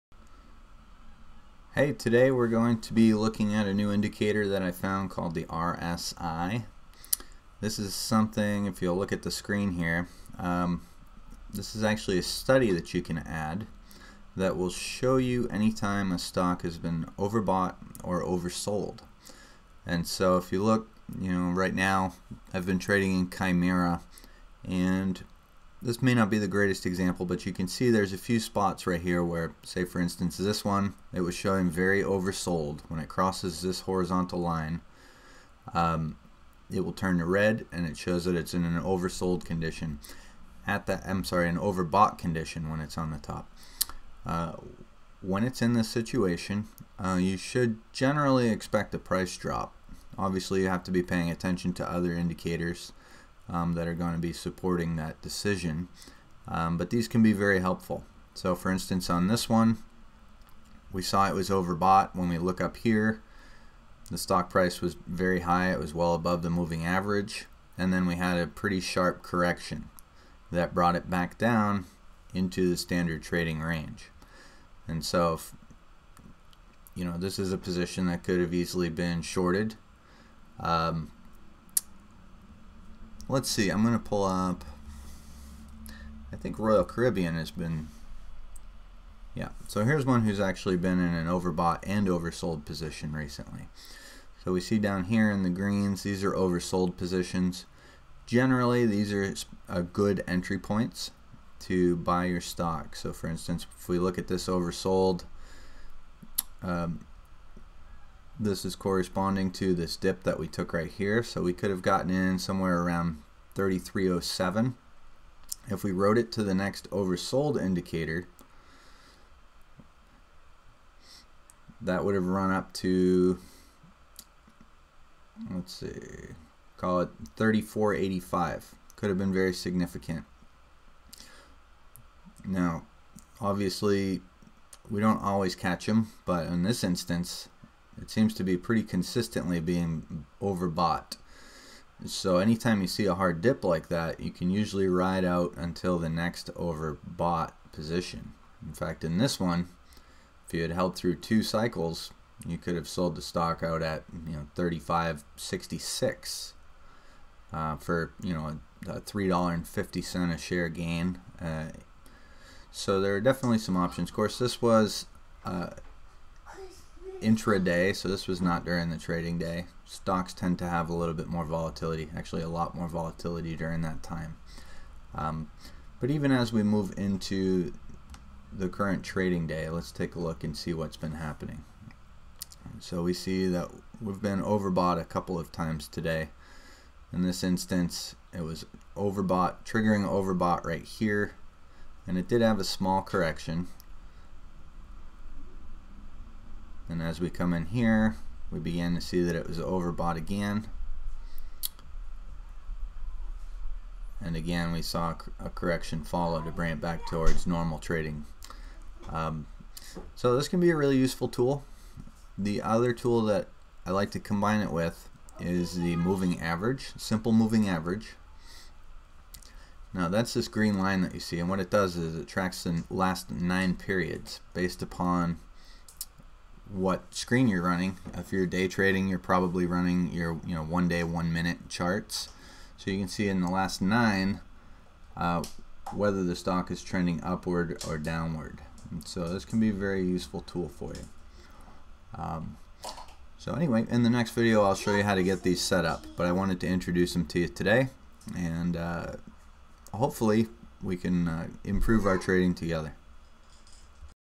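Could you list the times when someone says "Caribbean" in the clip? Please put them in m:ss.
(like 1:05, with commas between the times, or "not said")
1:26.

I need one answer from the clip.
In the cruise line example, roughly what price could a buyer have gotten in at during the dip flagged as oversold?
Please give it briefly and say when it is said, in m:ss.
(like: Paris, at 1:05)
33.07, at 1:53.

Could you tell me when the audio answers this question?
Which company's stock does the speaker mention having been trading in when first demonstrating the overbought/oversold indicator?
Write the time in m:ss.
0:23.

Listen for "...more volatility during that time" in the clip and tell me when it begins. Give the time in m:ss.
2:52.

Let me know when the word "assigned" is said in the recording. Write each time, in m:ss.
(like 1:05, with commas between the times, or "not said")
not said.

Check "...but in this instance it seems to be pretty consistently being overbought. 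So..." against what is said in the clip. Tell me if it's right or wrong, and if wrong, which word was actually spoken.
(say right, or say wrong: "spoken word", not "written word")
right.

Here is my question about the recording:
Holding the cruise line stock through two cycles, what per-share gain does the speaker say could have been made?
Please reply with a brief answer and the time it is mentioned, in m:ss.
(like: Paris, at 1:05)
$3.50, at 2:39.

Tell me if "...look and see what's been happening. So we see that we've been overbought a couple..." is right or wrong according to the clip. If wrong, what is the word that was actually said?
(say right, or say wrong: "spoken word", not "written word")
right.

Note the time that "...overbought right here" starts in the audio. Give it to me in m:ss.
3:10.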